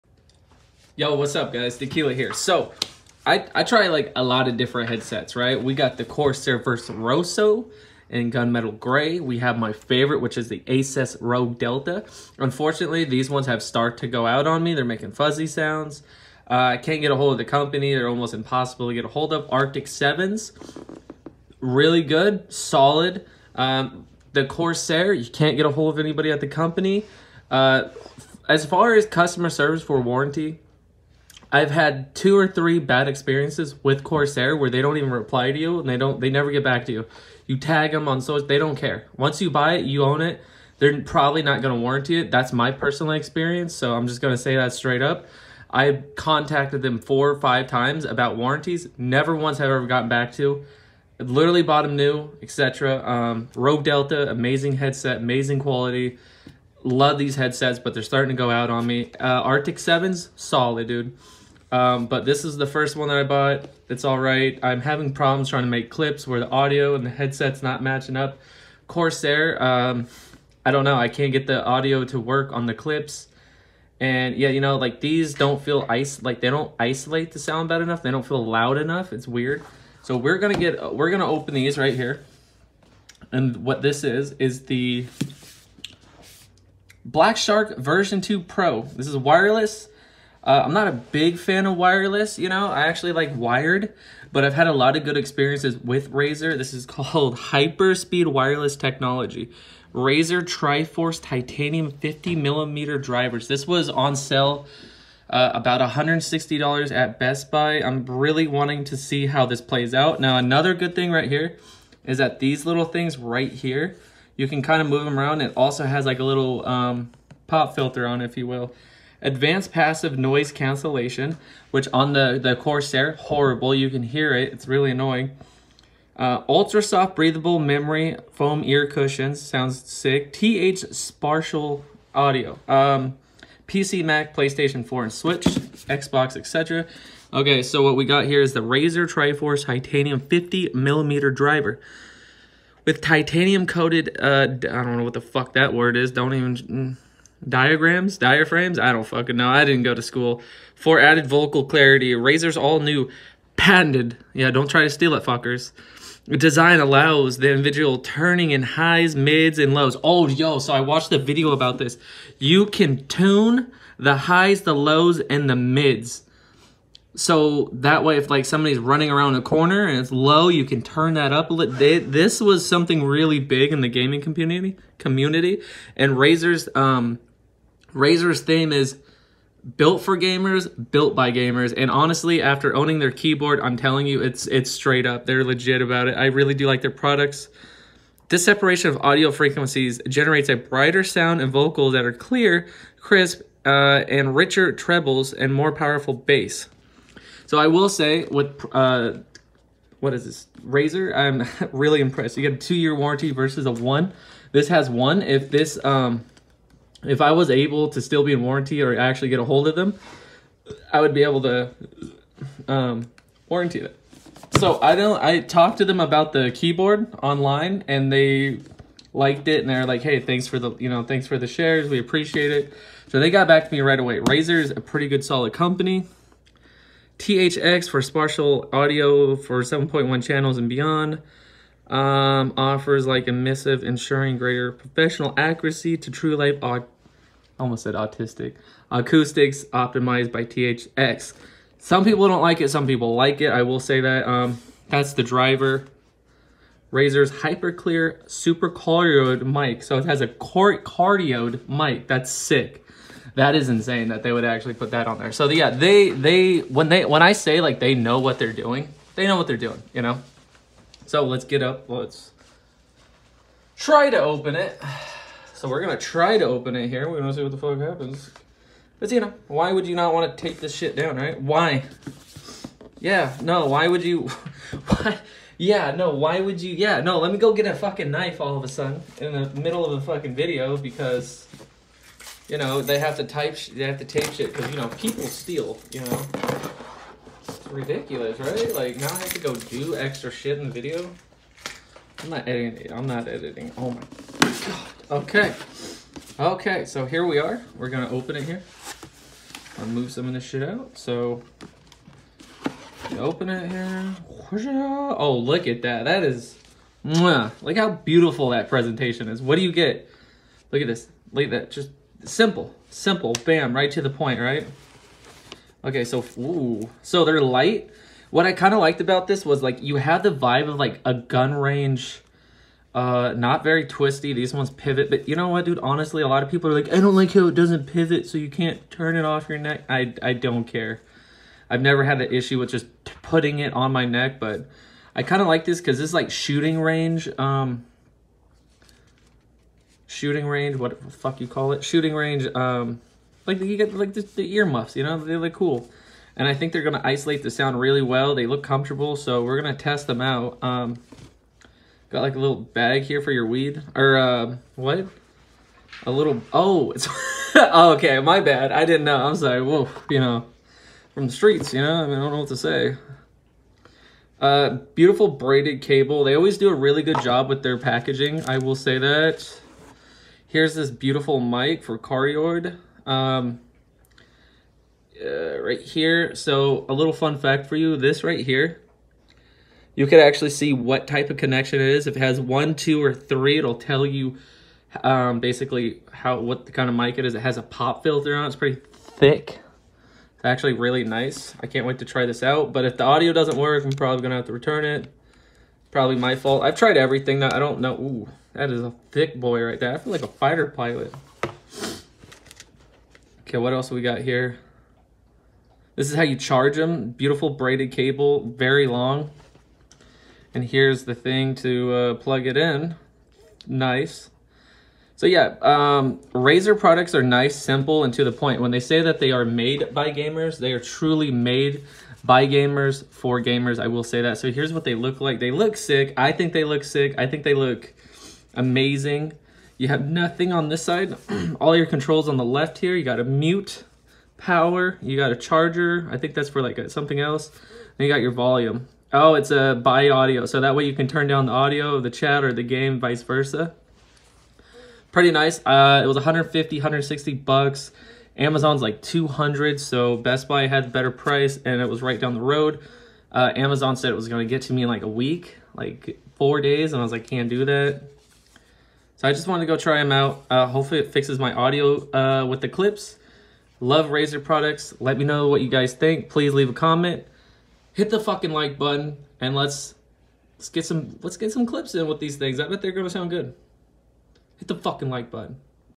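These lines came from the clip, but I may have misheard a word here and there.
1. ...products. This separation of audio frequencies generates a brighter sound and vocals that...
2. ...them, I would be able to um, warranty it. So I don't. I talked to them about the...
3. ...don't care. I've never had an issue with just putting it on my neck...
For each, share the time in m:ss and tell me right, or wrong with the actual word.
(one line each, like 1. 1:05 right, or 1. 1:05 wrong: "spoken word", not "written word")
1. 3:06 right
2. 3:29 right
3. 5:30 right.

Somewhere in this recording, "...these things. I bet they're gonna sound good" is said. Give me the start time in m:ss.
7:52.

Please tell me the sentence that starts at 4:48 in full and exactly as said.
Like now I have to go do extra shit in the video.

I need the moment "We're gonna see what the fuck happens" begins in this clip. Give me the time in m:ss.
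4:27.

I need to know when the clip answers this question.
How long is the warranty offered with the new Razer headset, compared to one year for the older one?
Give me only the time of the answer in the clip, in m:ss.
3:22.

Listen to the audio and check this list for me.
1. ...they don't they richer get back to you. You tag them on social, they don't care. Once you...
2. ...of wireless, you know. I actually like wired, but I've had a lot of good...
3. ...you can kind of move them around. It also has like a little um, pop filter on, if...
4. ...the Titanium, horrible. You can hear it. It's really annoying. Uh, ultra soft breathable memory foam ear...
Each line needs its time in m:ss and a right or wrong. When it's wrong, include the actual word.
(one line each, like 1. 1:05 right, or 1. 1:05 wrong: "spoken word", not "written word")
1. 0:35 wrong: "never", not "richer"
2. 1:31 right
3. 1:54 right
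4. 2:02 wrong: "Corsair", not "Titanium".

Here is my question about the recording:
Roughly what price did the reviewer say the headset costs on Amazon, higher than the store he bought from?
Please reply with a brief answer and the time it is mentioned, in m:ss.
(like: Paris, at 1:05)
$200, at 7:28.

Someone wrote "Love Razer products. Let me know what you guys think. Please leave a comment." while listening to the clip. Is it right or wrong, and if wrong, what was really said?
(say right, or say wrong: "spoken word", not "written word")
right.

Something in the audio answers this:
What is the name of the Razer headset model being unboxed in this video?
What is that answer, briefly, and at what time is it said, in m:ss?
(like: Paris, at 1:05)
Black Shark version 2 Pro, at 1:27.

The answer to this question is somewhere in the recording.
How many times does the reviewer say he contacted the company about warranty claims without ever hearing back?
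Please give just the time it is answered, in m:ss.
0:46.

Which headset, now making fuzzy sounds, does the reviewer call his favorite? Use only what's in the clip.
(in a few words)
Asus Rogue Delta.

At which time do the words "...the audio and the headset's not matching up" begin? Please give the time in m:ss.
1:06.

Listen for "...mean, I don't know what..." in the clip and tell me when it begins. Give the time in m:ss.
6:02.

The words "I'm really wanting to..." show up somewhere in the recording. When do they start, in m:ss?
1:47.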